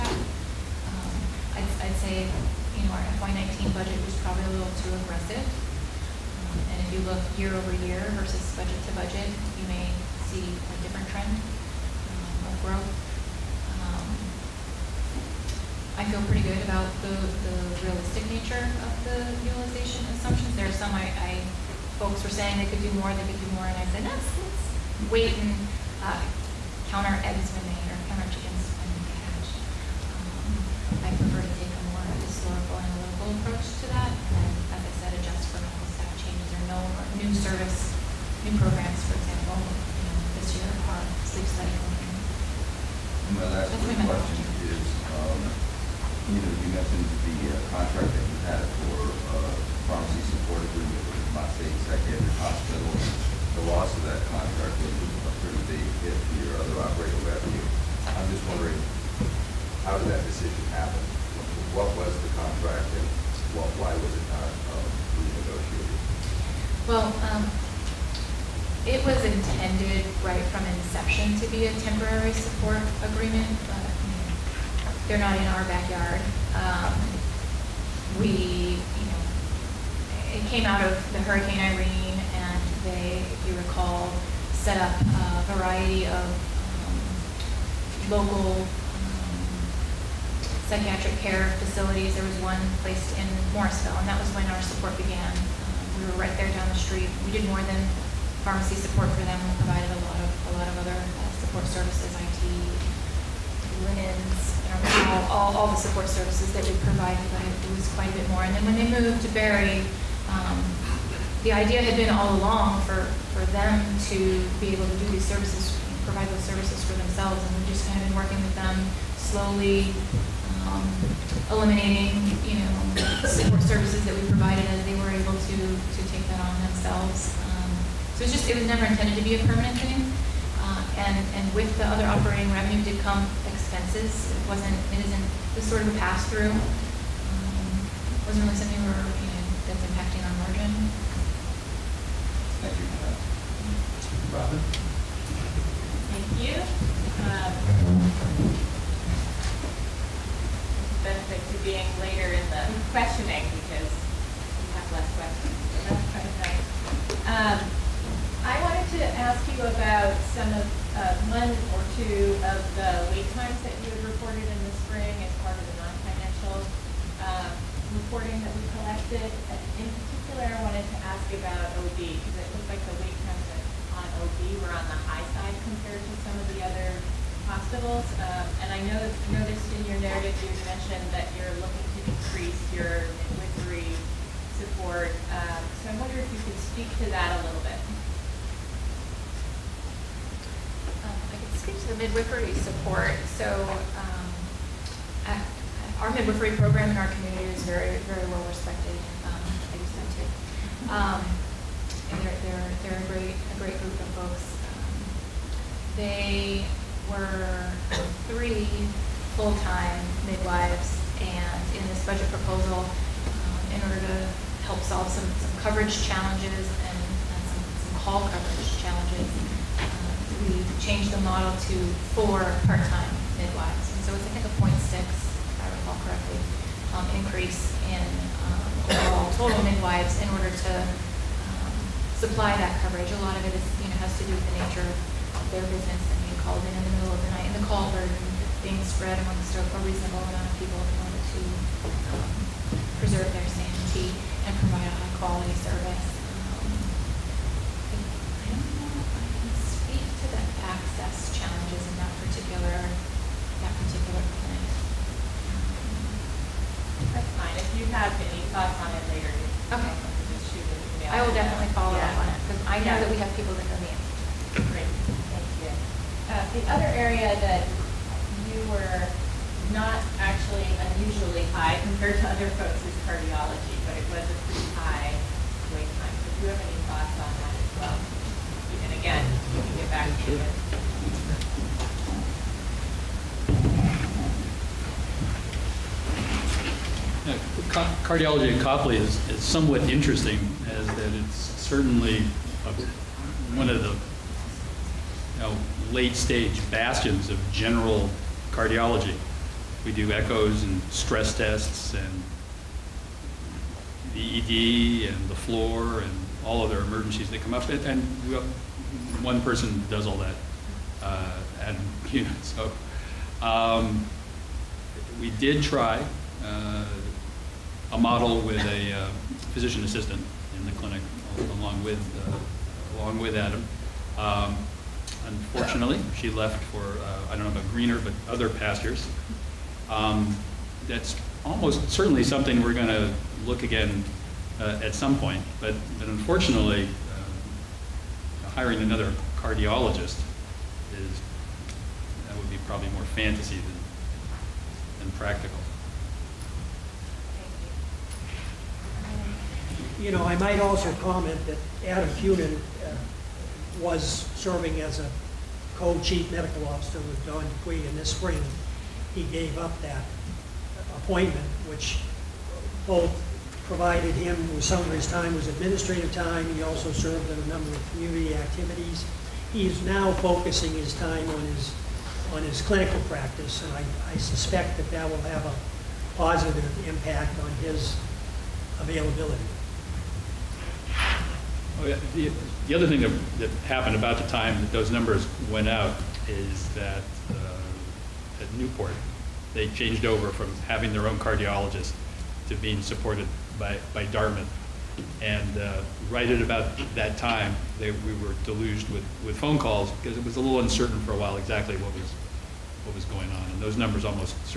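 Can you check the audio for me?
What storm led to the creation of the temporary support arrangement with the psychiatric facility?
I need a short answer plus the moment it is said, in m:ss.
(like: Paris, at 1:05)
Hurricane Irene, at 1:21.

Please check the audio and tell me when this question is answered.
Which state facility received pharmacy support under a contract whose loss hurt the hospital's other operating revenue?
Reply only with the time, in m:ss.
0:51.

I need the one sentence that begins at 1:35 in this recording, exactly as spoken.
Um, we were right there down the street.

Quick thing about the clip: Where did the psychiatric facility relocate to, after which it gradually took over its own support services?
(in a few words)
Barre.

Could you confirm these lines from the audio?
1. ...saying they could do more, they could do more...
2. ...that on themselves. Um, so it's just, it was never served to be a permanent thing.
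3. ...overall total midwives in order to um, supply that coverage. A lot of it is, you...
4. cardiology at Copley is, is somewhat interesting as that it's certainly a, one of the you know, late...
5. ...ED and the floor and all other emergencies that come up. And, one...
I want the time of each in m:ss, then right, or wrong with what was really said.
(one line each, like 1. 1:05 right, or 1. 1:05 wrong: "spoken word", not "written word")
1. 0:22 right
2. 2:06 wrong: "intended", not "served"
3. 3:48 right
4. 4:48 right
5. 5:04 right.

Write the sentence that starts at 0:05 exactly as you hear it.
Um, and if you look year over year versus budget to budget, you may see a different trend um, of growth.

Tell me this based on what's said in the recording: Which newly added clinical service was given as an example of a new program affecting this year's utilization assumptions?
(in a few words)
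sleep study program.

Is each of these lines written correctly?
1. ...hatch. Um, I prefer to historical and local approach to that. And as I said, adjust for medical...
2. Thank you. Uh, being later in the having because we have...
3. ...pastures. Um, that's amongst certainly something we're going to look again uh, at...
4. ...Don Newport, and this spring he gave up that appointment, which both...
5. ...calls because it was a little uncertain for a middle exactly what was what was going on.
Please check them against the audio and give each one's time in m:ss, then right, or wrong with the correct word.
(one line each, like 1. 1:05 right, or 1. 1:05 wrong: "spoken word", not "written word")
1. 0:29 right
2. 2:26 wrong: "questioning", not "having"
3. 5:28 wrong: "almost", not "amongst"
4. 5:57 wrong: "Dupuy", not "Newport"
5. 6:39 wrong: "while", not "middle".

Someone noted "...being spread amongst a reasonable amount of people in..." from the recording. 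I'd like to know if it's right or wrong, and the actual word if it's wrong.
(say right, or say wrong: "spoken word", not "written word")
right.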